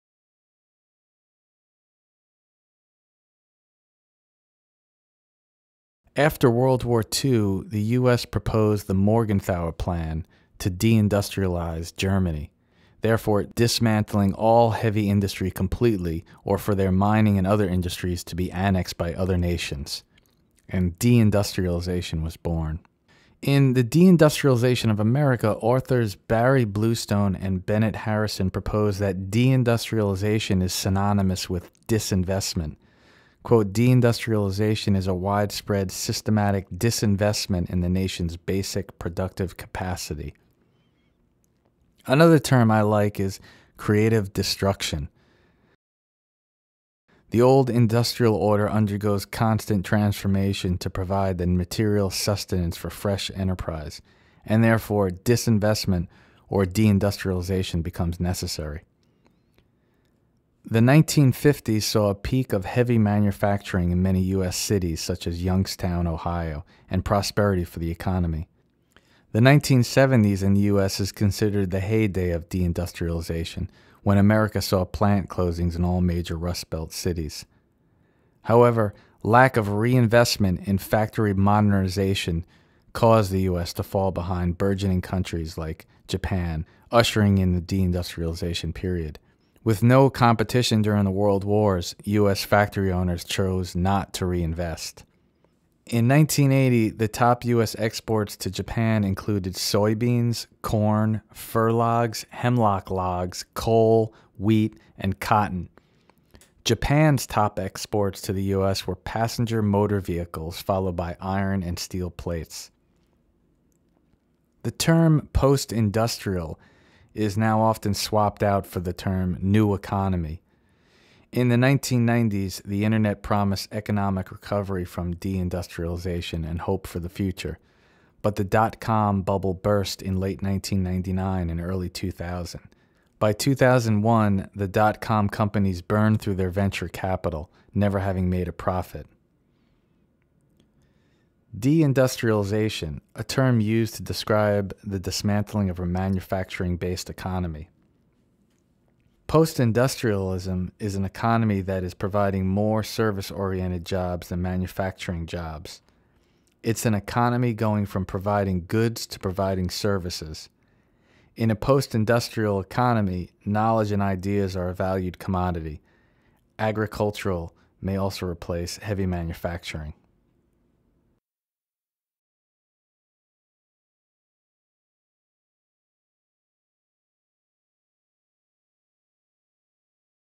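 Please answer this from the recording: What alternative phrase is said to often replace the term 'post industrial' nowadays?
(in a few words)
New economy.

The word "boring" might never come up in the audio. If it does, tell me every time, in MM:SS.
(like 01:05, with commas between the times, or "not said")
not said.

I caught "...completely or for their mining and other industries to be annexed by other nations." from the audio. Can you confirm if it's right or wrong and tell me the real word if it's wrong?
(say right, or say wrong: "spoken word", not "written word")
right.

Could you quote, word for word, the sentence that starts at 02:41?
In a post industrial economy, knowledge and ideas are a valued commodity.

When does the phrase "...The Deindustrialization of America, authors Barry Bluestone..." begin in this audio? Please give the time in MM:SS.
00:23.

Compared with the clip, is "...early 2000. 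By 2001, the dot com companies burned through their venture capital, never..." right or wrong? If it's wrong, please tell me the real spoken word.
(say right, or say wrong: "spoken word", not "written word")
right.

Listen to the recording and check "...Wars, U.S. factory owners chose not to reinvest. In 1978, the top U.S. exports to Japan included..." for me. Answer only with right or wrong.
wrong.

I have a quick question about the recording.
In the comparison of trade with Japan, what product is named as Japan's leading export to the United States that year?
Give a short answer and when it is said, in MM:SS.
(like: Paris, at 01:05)
Passenger motor vehicles, at 01:48.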